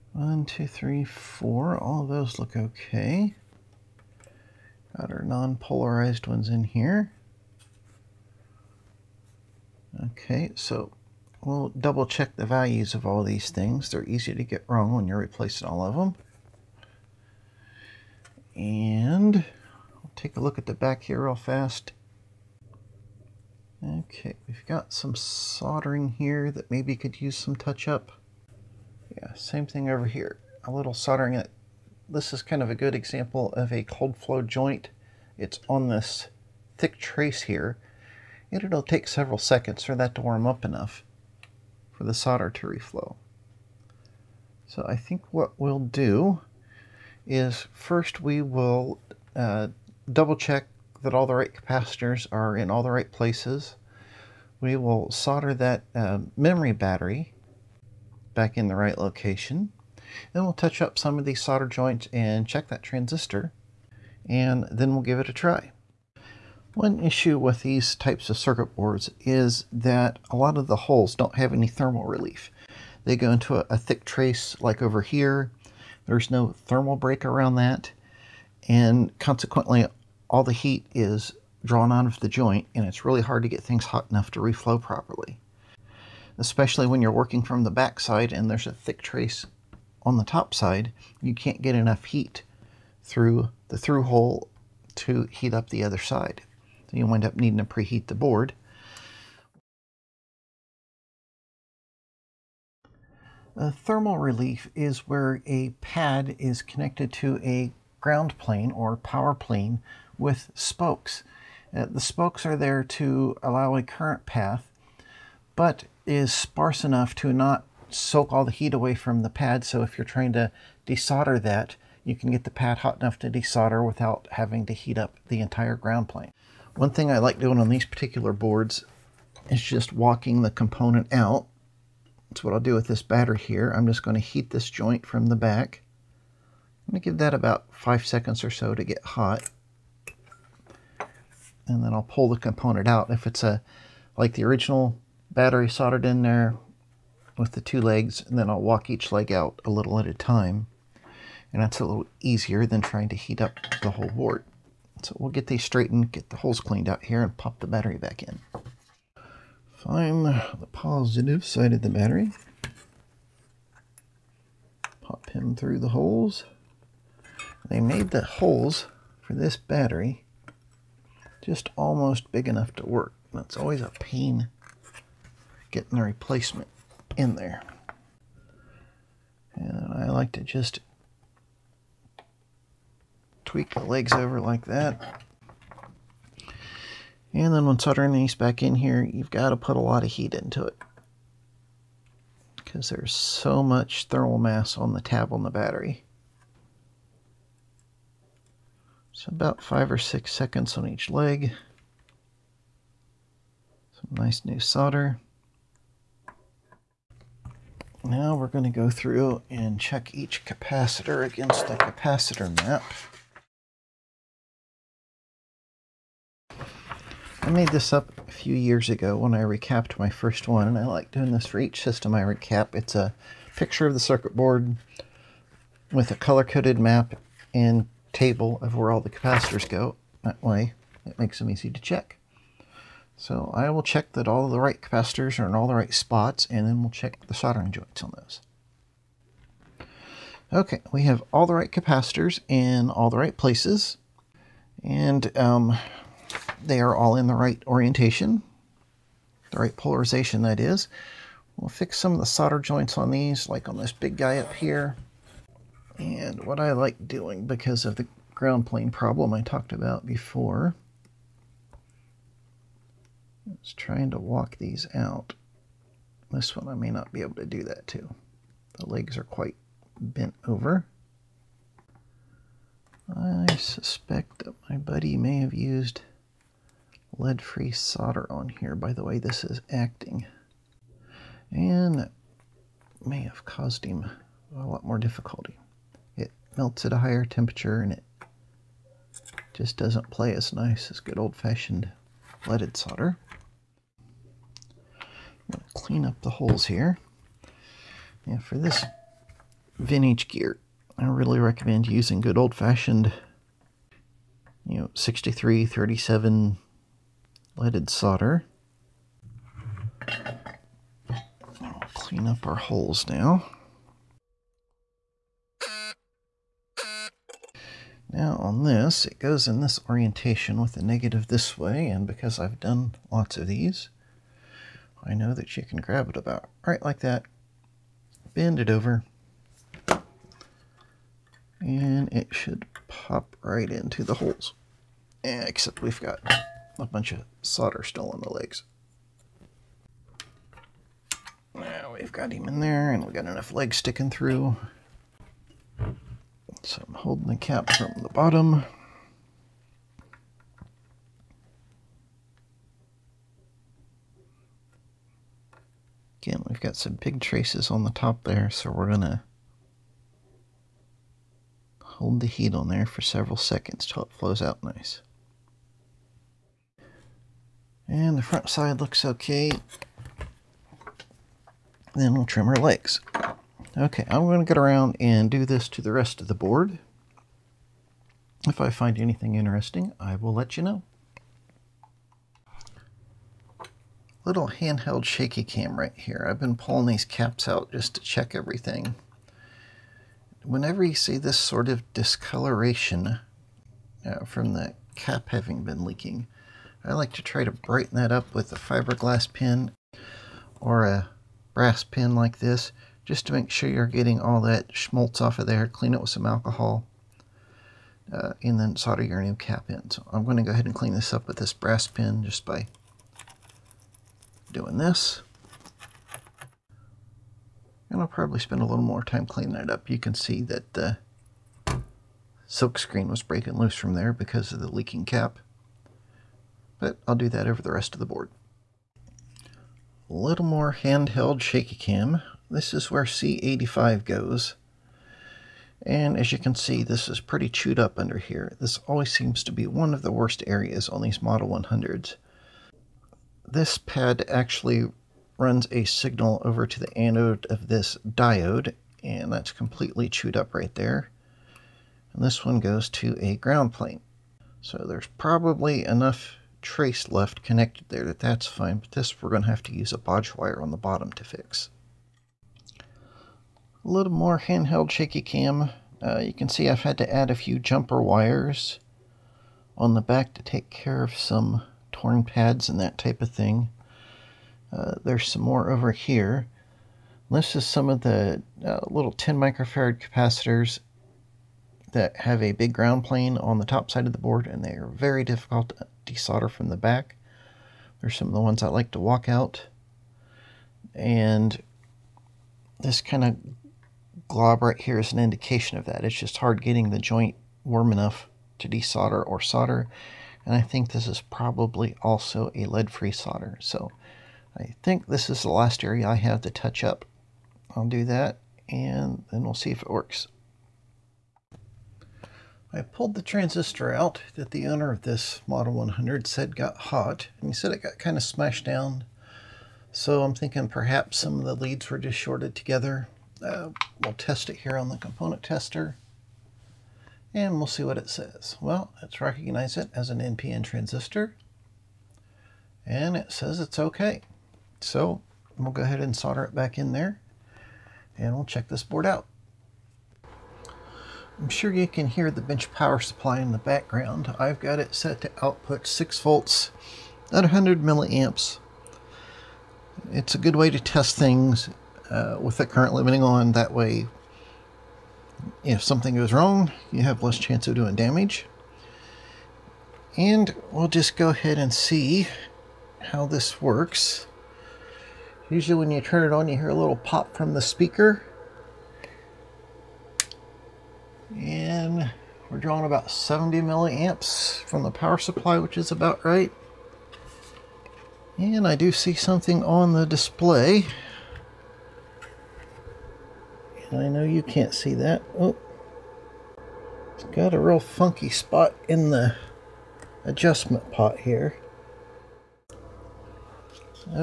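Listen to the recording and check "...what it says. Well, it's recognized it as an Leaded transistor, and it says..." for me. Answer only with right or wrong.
wrong.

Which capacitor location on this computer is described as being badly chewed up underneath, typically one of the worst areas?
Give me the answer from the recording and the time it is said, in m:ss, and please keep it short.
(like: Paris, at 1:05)
C85, at 7:13.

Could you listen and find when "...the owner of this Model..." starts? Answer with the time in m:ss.
8:34.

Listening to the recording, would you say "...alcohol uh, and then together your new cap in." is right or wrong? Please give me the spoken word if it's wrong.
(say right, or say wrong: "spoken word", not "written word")
wrong: "solder", not "together".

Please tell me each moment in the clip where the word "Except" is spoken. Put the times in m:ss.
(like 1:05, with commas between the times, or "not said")
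5:35.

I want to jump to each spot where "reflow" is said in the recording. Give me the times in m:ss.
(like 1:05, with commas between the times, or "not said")
0:42, 1:24.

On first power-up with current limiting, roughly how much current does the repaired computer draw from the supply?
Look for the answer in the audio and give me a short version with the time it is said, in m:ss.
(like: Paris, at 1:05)
70 milliamps, at 9:33.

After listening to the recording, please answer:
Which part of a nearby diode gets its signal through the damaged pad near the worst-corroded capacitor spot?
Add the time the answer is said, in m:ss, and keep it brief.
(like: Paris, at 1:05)
The anode, at 7:26.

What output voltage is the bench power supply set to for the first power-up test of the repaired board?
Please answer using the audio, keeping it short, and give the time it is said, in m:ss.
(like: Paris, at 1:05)
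6 volts, at 9:05.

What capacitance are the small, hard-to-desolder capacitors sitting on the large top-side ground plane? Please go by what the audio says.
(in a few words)
10 microfarads.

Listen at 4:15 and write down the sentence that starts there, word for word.
And what I like doing because of the ground plane problem I talked about before, is trying to walk these out.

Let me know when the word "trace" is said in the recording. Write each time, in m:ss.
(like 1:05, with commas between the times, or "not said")
0:36, 1:14, 1:29, 5:57, 7:36.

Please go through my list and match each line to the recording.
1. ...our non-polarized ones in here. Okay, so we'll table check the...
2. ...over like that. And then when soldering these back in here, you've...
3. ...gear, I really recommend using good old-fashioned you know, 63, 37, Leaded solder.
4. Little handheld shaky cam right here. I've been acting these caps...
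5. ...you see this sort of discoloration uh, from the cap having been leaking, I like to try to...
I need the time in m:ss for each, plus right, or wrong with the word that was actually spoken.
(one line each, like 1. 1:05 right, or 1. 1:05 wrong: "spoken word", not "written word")
1. 0:05 wrong: "double", not "table"
2. 3:04 right
3. 5:00 right
4. 6:24 wrong: "pulling", not "acting"
5. 6:30 right.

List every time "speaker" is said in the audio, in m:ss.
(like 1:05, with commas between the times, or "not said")
9:27.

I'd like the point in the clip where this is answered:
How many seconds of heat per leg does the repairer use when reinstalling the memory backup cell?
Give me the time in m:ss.
3:19.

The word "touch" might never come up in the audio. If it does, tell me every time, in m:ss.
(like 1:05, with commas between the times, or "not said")
0:27, 1:00, 8:26.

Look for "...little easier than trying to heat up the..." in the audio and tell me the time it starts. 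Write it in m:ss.
2:31.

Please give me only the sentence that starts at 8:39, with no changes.
So I'm thinking perhaps some of the leads were just shorted together.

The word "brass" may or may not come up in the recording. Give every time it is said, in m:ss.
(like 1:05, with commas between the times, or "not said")
6:41, 6:51.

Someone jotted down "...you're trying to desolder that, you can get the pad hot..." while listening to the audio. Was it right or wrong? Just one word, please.
right.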